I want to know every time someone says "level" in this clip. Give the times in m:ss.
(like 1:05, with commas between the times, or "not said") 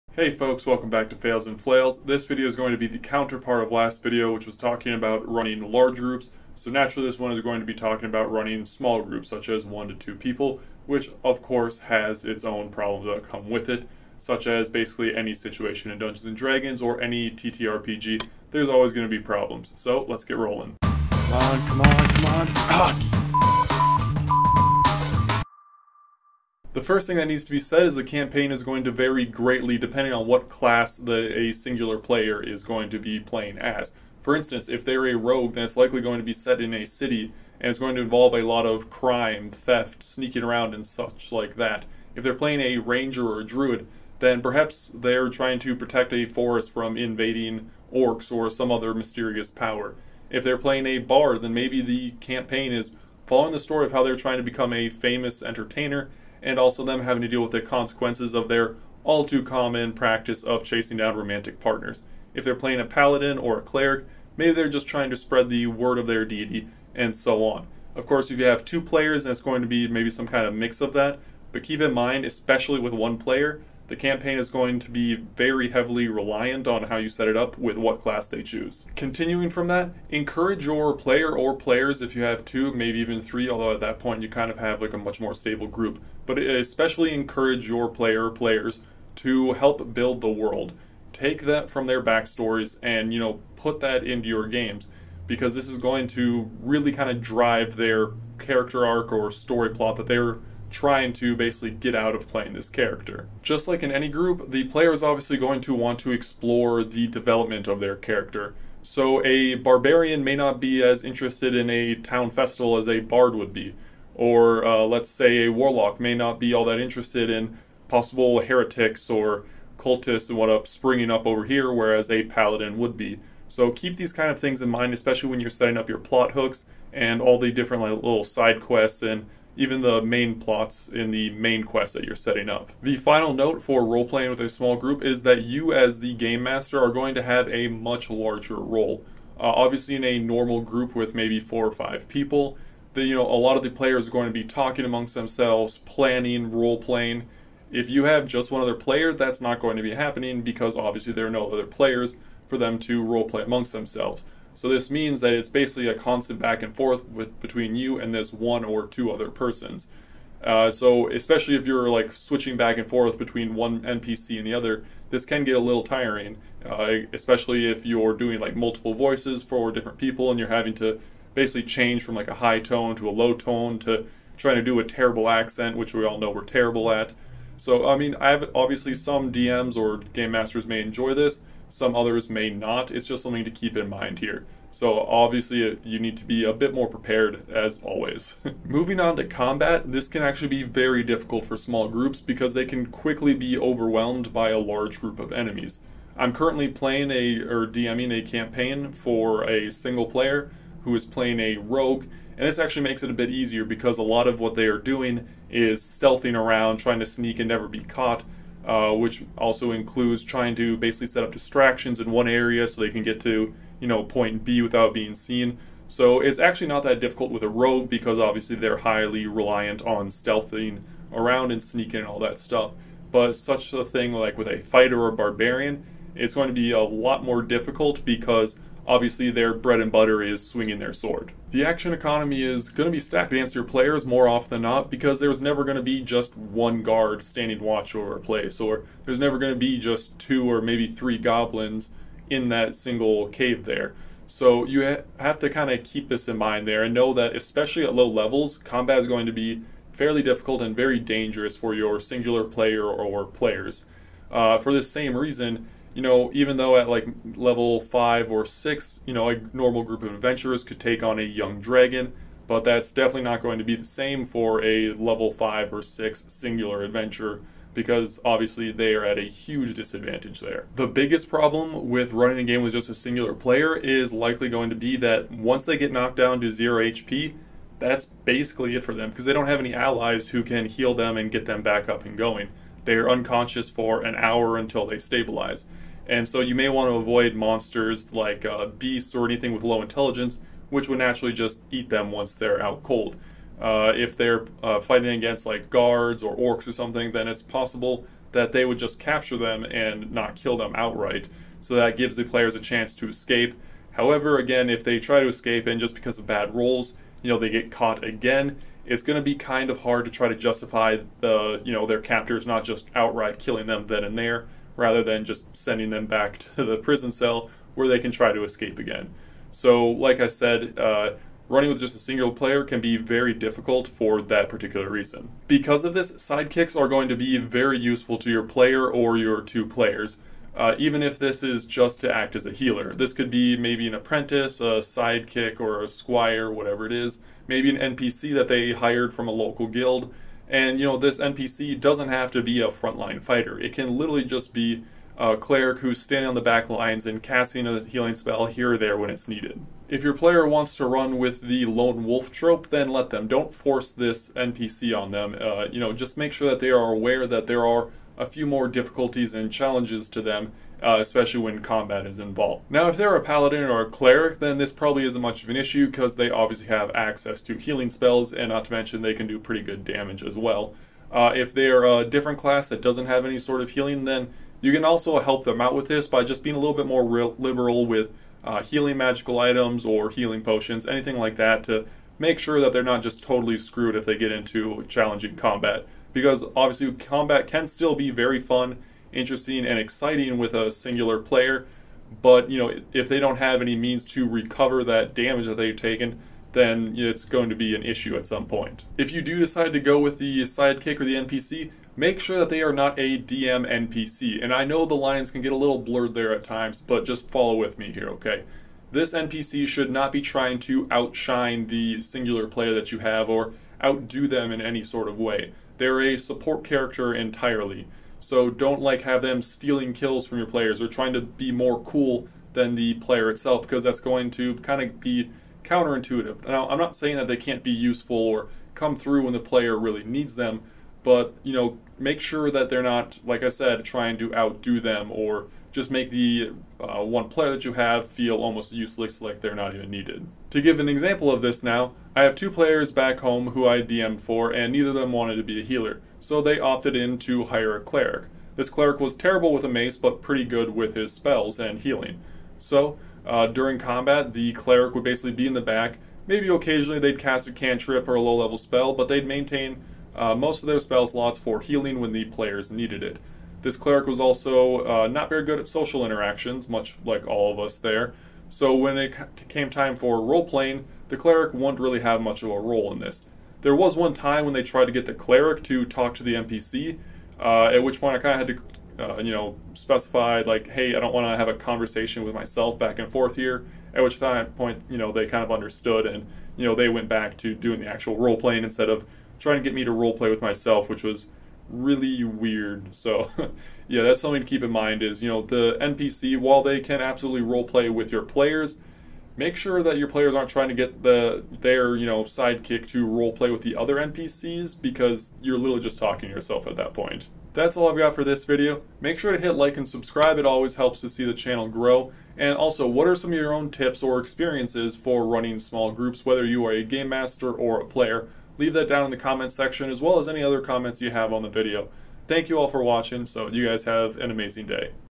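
4:08, 4:17, 4:24, 7:38.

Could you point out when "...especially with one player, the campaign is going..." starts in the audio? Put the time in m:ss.
1:12.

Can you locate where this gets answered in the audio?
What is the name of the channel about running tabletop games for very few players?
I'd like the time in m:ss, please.
0:01.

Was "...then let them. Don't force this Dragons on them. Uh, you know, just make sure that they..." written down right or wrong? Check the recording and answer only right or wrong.
wrong.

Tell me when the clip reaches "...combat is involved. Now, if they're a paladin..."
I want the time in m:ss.
6:01.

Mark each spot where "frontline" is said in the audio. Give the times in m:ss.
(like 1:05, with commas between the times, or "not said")
5:42.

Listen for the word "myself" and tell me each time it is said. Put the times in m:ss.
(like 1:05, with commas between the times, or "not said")
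8:02, 8:10.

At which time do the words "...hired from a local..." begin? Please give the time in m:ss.
5:38.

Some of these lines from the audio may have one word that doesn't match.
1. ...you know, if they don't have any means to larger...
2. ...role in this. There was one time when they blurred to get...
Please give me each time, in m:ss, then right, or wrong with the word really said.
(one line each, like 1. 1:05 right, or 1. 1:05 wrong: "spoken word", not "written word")
1. 6:32 wrong: "recover", not "larger"
2. 7:52 wrong: "tried", not "blurred".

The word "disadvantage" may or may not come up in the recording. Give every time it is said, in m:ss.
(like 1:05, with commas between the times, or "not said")
4:29.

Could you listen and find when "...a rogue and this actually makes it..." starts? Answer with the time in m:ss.
3:21.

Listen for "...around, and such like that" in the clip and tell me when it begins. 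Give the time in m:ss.
0:40.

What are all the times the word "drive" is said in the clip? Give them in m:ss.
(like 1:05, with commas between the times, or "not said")
1:37.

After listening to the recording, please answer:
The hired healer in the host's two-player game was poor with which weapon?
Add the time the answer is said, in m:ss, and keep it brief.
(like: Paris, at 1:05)
mace, at 7:29.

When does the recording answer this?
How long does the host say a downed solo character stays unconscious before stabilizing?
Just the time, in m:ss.
4:44.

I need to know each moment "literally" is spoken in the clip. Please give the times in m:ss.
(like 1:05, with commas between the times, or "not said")
5:43, 8:25.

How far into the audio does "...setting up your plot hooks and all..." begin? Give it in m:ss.
2:05.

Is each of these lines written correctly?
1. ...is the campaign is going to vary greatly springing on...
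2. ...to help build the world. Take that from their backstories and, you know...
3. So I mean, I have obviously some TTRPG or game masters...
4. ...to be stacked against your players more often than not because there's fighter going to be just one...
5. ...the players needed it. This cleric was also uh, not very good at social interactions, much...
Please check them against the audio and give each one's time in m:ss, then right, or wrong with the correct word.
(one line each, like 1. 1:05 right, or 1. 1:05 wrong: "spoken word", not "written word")
1. 0:27 wrong: "depending", not "springing"
2. 1:29 right
3. 2:57 wrong: "DMs", not "TTRPG"
4. 3:52 wrong: "never", not "fighter"
5. 7:42 right.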